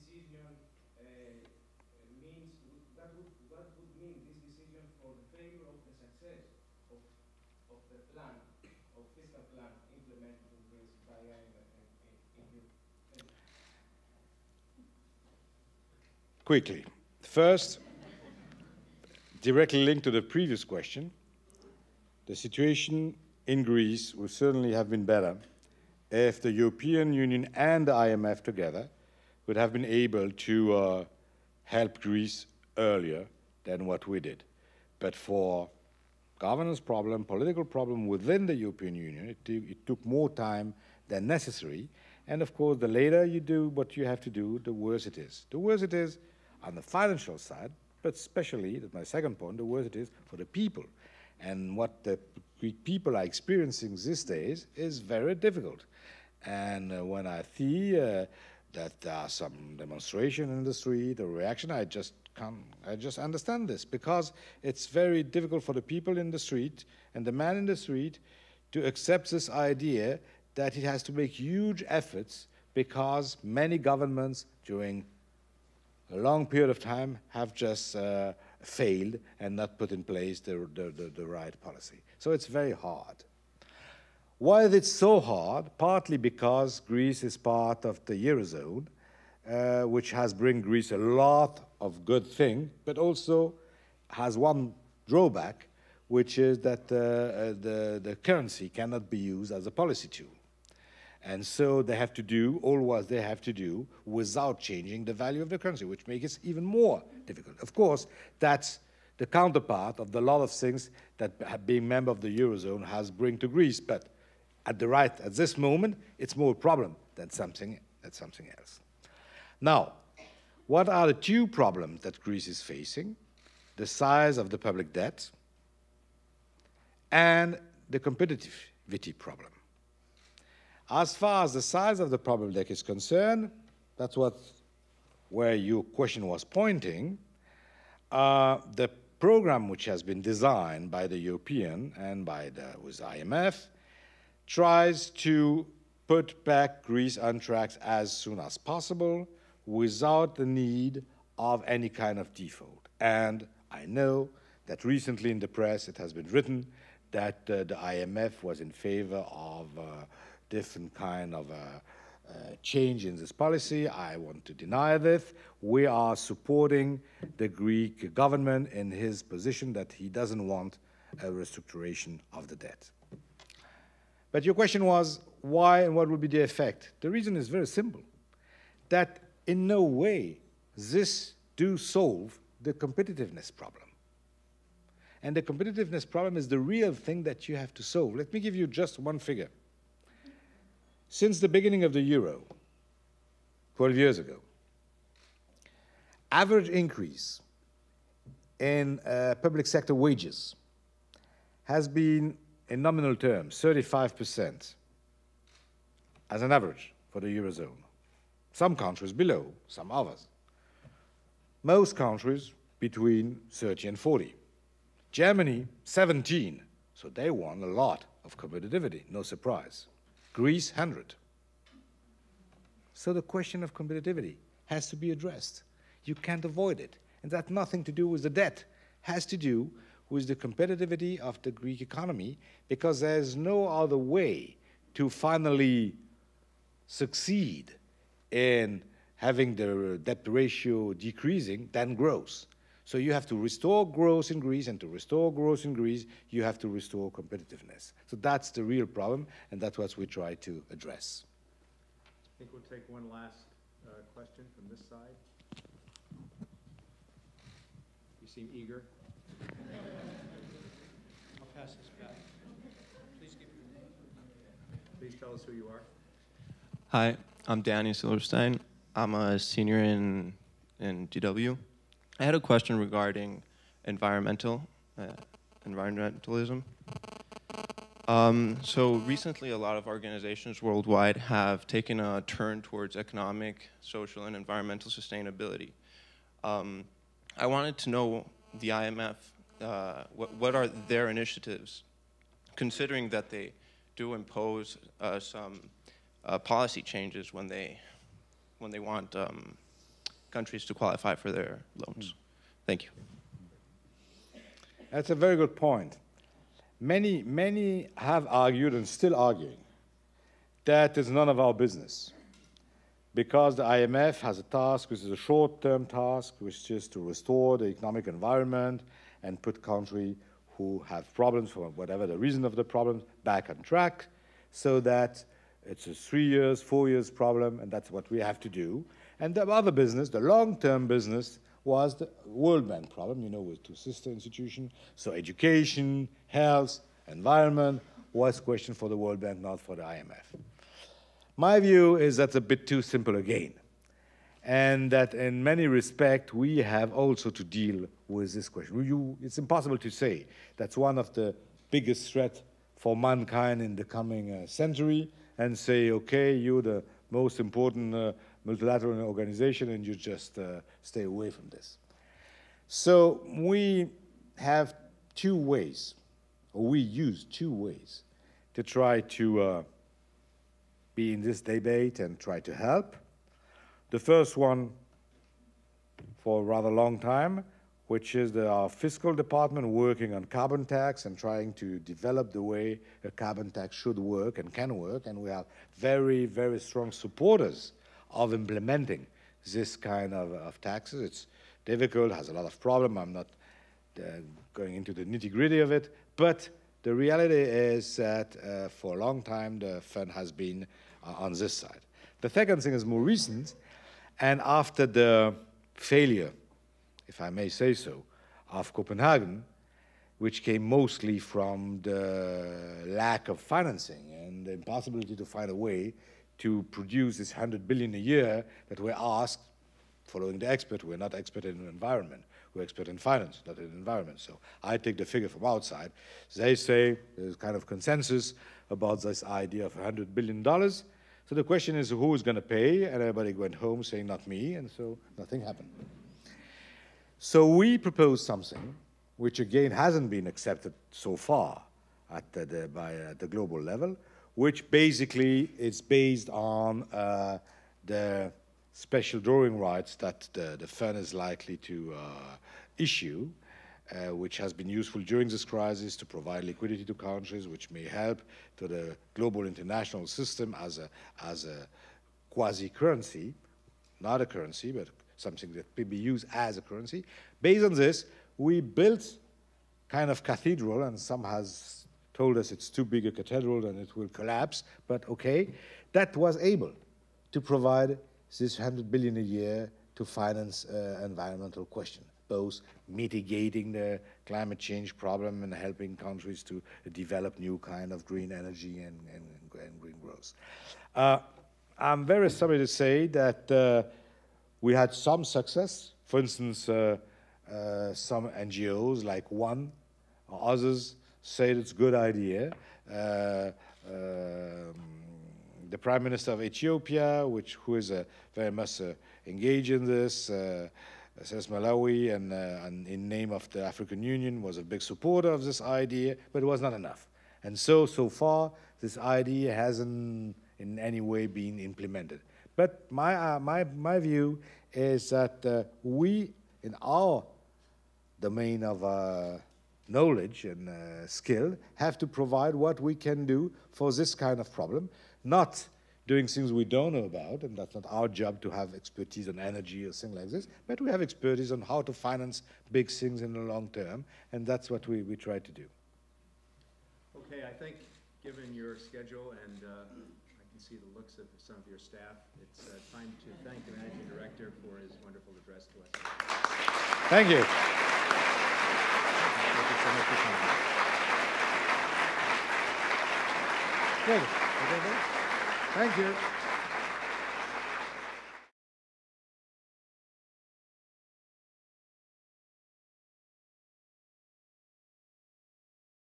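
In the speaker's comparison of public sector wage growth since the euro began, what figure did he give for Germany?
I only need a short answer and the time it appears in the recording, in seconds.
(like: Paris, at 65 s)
17, at 215 s.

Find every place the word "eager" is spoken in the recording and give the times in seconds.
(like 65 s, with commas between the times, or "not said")
258 s.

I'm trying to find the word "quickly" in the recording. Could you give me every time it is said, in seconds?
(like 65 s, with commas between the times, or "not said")
16 s.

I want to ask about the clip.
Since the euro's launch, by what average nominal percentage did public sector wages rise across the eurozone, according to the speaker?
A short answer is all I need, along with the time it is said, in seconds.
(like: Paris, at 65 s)
35%, at 203 s.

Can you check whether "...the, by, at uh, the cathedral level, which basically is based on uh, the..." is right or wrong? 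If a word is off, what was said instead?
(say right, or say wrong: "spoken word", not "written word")
wrong: "global", not "cathedral".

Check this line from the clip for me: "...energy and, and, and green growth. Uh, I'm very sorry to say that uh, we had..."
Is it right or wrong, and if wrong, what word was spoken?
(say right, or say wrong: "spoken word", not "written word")
right.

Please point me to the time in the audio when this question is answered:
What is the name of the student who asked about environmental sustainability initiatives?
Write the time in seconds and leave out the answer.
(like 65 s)
267 s.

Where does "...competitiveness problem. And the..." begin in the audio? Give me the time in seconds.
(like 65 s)
182 s.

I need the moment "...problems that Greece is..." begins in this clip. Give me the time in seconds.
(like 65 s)
121 s.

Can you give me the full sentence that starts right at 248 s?
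So that's the real problem, and that's what we try to address.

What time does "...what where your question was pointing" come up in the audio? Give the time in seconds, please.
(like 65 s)
134 s.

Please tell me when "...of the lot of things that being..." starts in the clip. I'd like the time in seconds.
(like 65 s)
109 s.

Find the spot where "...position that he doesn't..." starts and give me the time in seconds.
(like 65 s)
169 s.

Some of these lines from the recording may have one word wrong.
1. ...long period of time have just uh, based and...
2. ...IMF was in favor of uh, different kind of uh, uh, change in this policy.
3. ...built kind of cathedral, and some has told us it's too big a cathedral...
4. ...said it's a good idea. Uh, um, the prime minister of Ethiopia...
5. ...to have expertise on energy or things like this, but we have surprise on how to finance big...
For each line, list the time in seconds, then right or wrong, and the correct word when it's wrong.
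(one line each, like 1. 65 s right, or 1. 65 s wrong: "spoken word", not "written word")
1. 76 s wrong: "failed", not "based"
2. 157 s right
3. 468 s right
4. 501 s right
5. 538 s wrong: "expertise", not "surprise".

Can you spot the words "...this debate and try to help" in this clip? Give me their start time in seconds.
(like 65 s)
371 s.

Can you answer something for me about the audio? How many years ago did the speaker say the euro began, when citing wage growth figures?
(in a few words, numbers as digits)
12.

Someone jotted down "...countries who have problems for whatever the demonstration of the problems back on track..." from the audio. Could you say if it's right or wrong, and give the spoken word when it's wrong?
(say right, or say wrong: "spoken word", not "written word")
wrong: "reason", not "demonstration".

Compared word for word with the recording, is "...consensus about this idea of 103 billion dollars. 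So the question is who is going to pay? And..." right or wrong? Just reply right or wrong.
wrong.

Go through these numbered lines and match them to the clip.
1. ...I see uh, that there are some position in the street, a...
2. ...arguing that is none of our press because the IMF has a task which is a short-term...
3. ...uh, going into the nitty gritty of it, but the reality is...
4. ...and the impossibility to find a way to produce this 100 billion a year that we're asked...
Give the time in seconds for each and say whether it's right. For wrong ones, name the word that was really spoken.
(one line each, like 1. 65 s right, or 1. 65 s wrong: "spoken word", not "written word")
1. 57 s wrong: "demonstration", not "position"
2. 309 s wrong: "business", not "press"
3. 393 s right
4. 414 s right.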